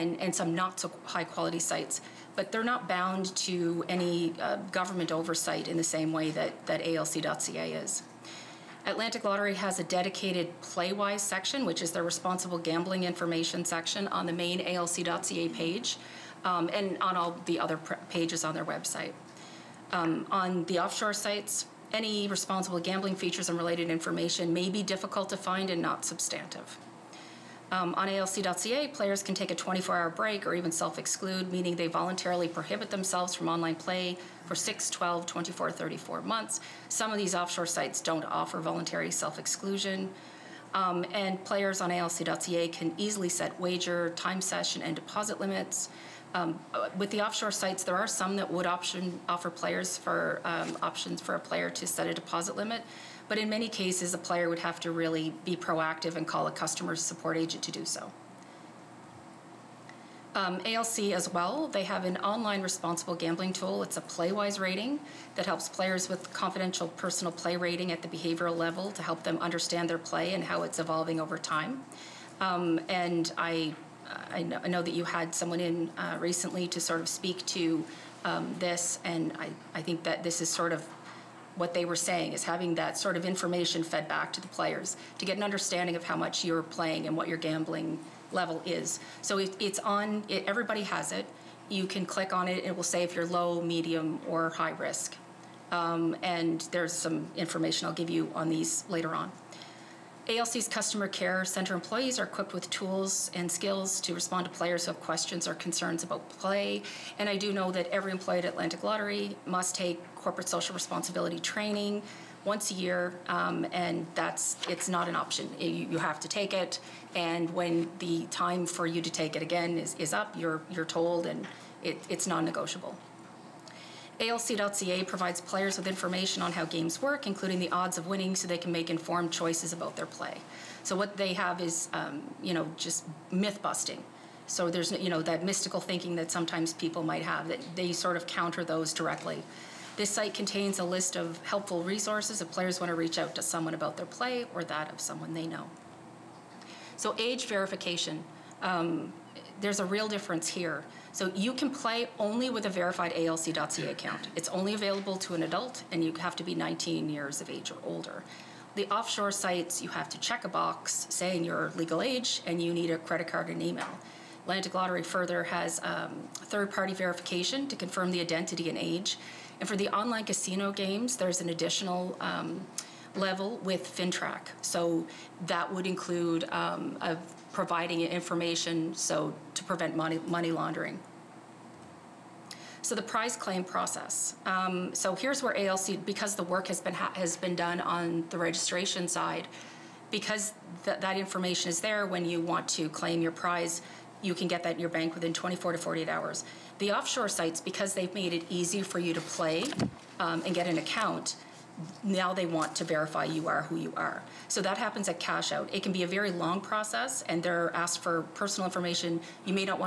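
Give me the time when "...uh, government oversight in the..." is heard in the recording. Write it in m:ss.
0:04.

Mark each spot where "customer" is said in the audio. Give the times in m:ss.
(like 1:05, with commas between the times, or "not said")
0:56, 1:40.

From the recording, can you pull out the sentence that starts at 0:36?
Some of these offshore sites don't offer voluntary self exclusion.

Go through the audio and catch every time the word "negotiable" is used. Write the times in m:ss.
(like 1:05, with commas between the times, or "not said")
2:02.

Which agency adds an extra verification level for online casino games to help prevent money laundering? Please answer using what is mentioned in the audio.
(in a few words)
FINTRAC.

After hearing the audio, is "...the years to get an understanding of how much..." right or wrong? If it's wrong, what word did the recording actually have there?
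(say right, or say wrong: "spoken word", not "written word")
wrong: "players", not "years".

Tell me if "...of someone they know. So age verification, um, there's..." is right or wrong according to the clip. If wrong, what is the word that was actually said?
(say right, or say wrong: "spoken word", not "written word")
right.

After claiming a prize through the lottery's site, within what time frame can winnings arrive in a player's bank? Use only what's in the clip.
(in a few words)
24 to 48 hours.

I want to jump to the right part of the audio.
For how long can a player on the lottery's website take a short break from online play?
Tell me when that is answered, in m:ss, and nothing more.
0:29.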